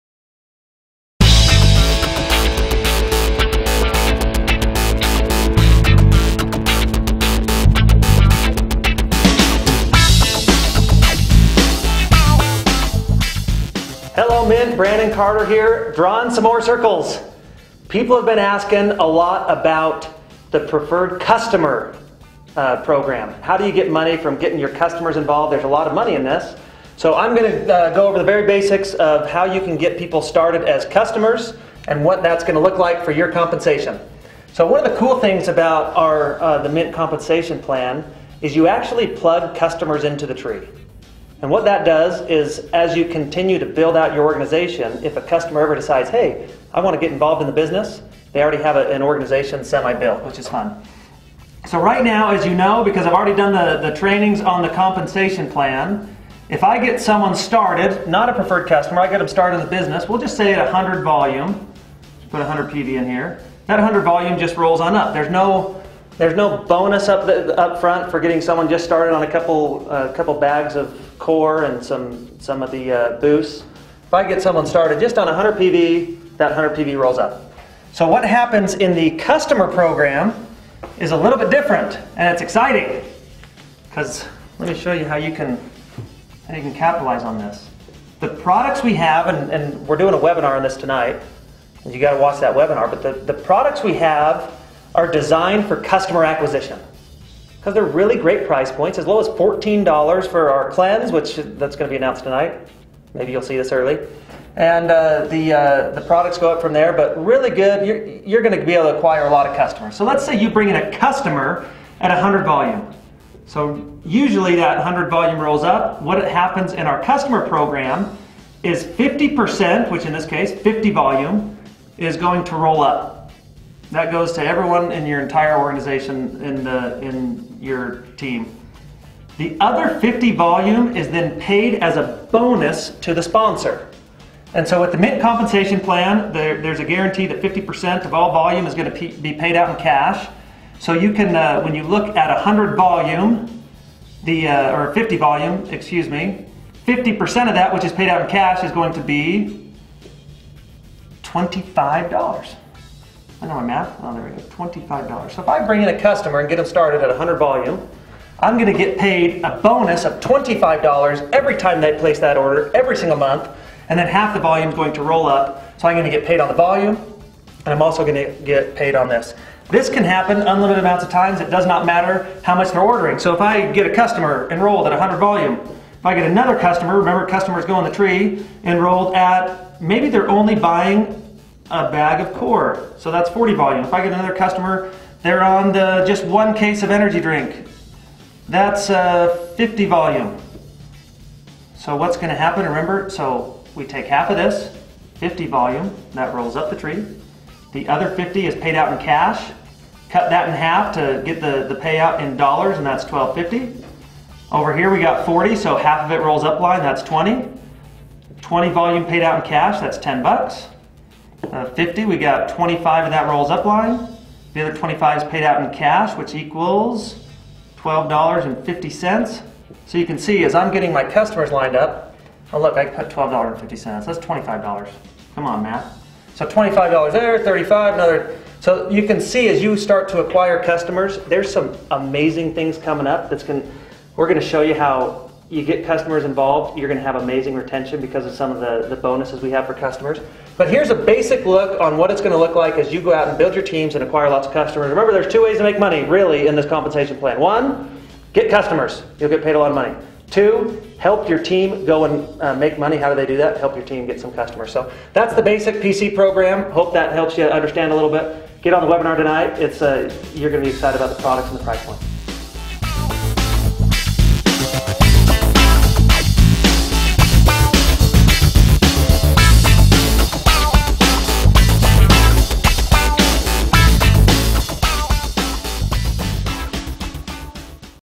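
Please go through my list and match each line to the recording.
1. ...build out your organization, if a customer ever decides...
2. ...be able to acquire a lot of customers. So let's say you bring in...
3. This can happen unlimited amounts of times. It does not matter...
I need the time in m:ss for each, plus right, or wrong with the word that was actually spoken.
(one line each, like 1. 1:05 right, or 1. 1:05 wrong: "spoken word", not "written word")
1. 0:43 right
2. 1:48 right
3. 2:49 right.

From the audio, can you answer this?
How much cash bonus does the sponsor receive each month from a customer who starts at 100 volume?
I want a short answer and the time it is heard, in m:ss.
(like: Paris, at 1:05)
$25, at 2:40.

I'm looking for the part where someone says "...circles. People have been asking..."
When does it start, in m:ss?
0:16.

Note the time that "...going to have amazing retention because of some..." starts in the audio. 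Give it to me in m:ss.
3:56.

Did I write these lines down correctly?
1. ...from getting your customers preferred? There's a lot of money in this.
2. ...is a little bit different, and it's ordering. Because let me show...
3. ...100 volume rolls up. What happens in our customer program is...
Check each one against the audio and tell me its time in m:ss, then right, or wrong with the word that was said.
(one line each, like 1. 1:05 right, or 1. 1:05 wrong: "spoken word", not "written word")
1. 0:24 wrong: "involved", not "preferred"
2. 1:20 wrong: "exciting", not "ordering"
3. 1:54 right.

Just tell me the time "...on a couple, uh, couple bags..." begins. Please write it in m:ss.
1:09.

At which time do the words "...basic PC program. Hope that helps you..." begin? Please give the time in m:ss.
4:15.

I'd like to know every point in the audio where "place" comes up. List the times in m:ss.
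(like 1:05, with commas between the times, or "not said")
2:41.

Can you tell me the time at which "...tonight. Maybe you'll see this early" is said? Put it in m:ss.
1:42.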